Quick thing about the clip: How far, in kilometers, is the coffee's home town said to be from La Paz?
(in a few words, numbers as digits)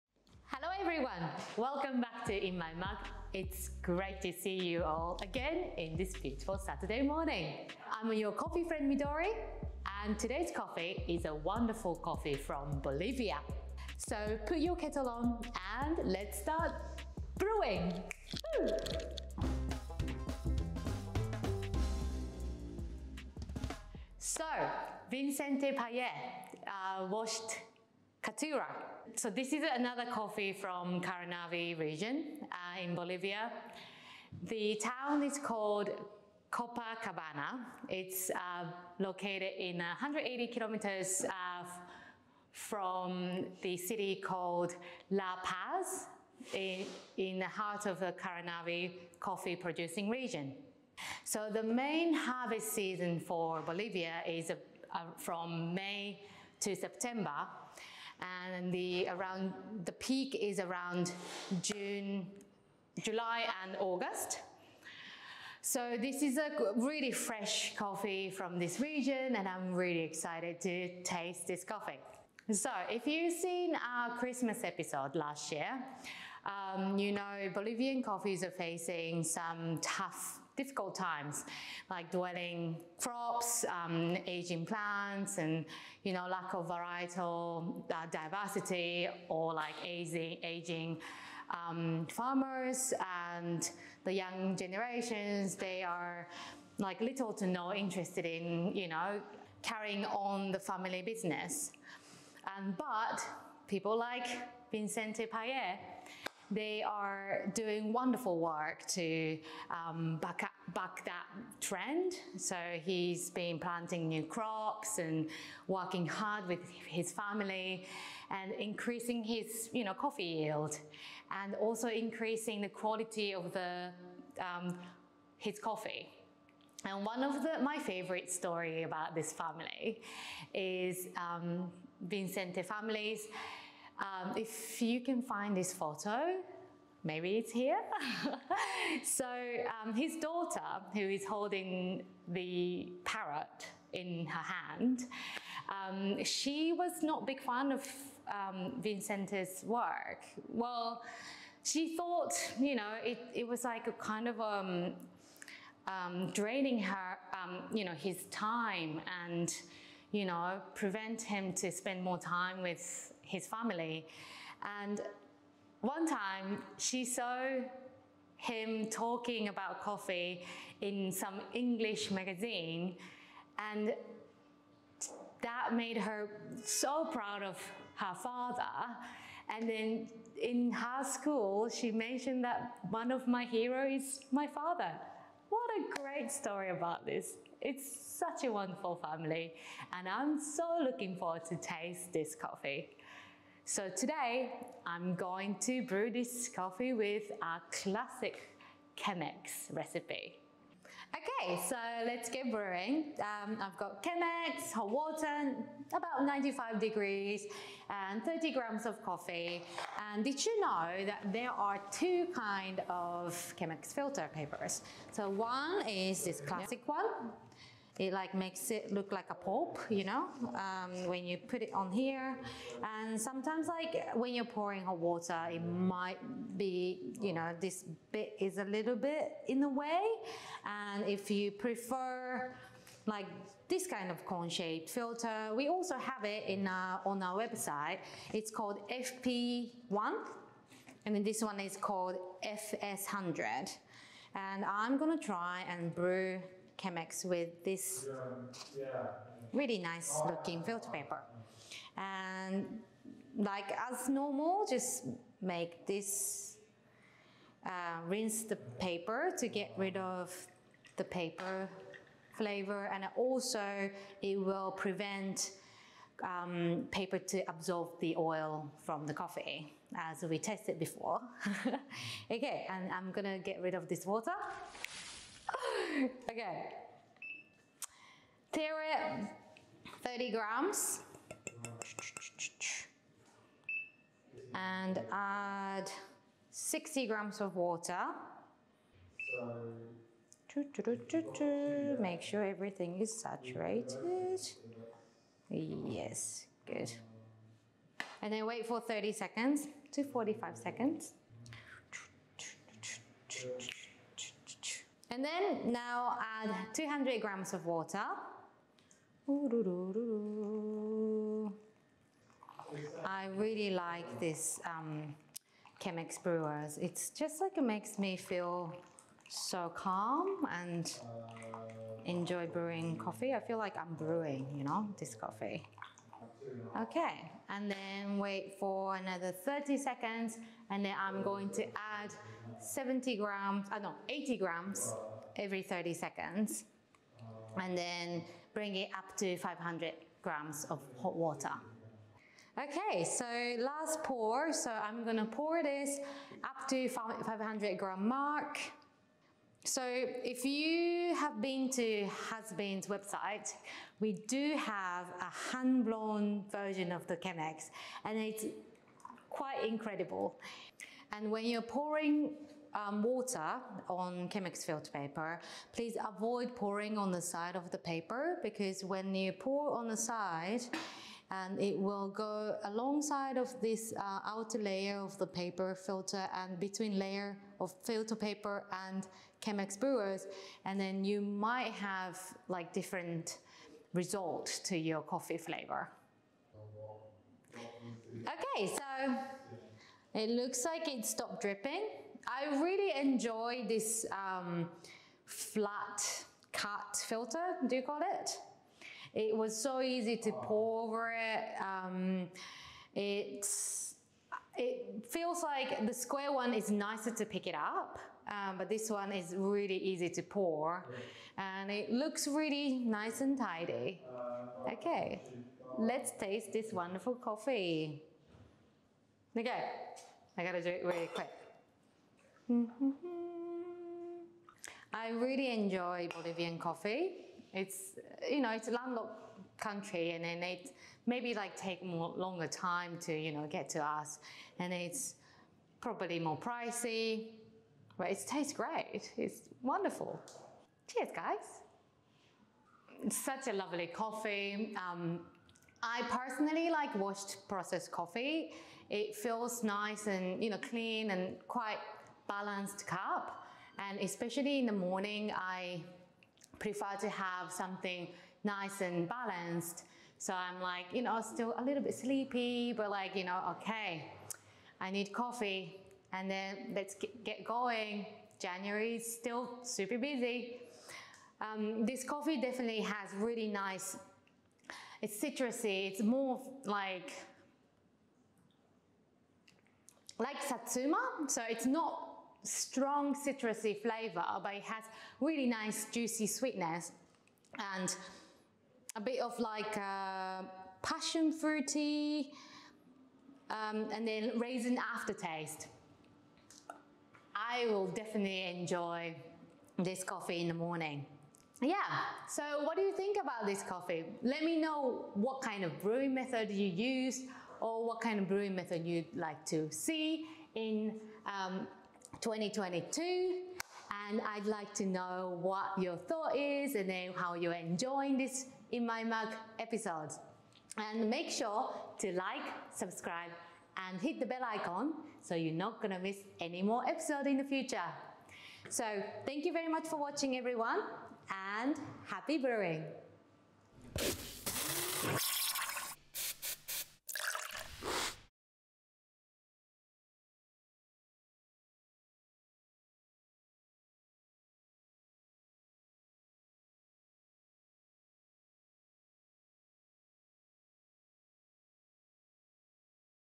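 180 kilometers.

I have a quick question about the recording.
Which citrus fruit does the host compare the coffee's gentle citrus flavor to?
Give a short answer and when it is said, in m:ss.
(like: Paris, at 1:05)
Satsuma, at 8:00.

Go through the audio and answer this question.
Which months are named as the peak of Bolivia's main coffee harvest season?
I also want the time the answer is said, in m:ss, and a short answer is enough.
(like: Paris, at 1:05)
June, July and August, at 1:01.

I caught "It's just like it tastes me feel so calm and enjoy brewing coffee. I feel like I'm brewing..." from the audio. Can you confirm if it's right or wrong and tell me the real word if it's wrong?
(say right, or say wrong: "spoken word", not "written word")
wrong: "makes", not "tastes".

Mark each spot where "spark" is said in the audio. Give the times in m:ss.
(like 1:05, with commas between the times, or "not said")
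not said.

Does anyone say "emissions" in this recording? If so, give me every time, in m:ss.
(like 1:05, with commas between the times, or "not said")
not said.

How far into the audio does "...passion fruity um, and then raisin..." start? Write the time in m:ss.
8:10.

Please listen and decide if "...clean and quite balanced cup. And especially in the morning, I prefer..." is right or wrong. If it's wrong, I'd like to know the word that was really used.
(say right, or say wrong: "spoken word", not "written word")
right.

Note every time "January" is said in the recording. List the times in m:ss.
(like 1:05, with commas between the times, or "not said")
7:48.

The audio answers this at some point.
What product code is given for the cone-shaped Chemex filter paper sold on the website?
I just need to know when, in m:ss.
3:58.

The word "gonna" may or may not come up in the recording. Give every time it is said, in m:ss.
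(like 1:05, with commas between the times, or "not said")
4:04, 4:33, 5:45.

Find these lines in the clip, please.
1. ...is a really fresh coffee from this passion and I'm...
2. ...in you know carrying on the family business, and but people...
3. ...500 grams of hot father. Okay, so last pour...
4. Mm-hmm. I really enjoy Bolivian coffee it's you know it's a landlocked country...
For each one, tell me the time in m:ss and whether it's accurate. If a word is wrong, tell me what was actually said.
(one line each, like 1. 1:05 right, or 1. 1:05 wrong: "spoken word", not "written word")
1. 1:06 wrong: "region", not "passion"
2. 1:38 right
3. 5:39 wrong: "water", not "father"
4. 7:02 right.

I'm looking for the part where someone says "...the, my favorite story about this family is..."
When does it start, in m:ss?
2:07.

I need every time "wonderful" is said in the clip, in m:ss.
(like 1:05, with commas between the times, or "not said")
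0:11, 1:47, 3:08, 6:56, 7:19.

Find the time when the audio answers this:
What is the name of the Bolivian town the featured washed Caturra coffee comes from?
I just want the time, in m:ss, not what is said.
0:36.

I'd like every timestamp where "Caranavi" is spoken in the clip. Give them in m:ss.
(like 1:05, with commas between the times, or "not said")
0:31, 0:48.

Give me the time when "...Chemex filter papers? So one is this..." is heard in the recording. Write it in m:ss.
3:33.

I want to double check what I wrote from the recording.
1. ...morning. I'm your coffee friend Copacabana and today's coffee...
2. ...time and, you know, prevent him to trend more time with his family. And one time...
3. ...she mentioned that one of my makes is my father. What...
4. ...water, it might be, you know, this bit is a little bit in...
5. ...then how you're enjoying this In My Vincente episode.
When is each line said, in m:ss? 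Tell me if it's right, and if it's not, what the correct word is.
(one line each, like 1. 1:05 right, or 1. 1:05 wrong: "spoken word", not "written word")
1. 0:07 wrong: "Midori", not "Copacabana"
2. 2:38 wrong: "spend", not "trend"
3. 3:01 wrong: "heroes", not "makes"
4. 3:44 right
5. 8:36 wrong: "Mug", not "Vincente".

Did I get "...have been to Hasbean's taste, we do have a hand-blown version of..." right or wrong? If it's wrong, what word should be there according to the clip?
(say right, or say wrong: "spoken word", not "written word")
wrong: "website", not "taste".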